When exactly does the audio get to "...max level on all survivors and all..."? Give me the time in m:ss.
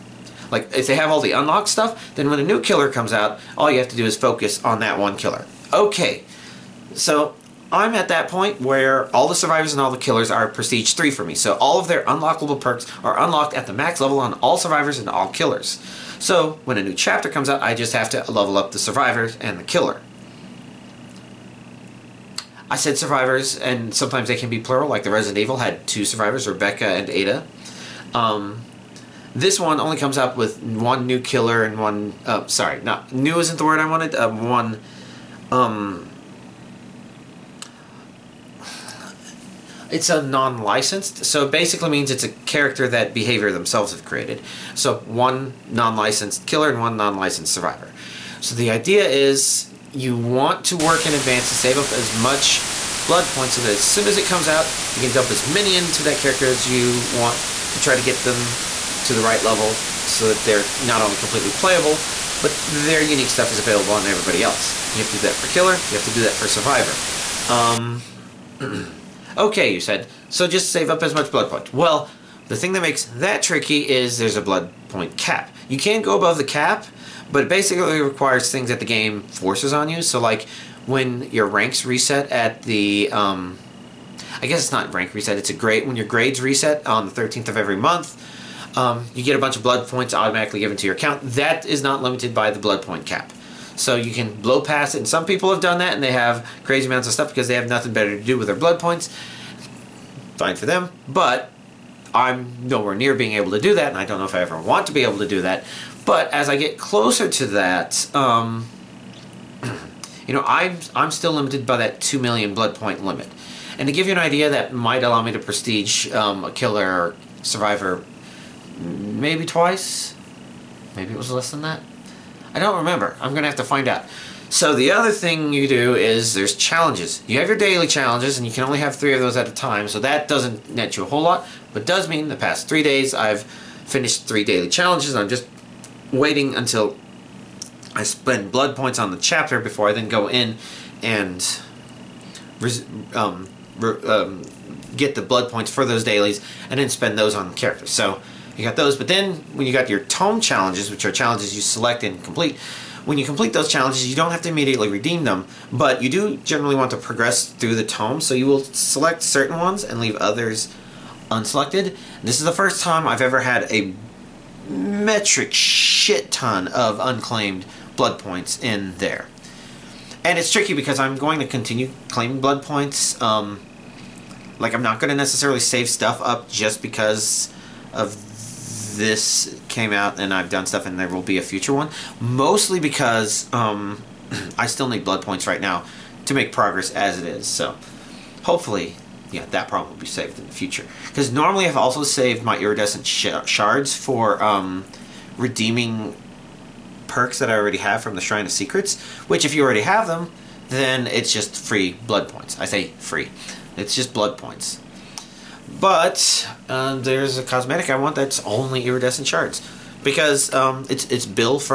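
0:13.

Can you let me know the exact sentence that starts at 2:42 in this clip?
This is the first time I've ever had a metric shit ton of unclaimed blood points in there.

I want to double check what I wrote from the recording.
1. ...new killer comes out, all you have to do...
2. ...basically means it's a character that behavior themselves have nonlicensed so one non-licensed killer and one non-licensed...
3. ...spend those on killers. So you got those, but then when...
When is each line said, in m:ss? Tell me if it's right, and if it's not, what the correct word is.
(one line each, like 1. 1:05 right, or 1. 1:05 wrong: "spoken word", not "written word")
1. 0:02 right
2. 0:41 wrong: "created", not "nonlicensed"
3. 2:26 wrong: "characters", not "killers".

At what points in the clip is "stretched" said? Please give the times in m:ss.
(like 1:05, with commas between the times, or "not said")
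not said.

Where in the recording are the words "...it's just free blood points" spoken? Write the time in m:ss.
3:21.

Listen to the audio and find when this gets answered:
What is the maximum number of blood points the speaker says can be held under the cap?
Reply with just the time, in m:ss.
1:52.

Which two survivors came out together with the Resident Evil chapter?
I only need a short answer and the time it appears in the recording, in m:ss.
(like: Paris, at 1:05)
Rebecca and Ada, at 0:26.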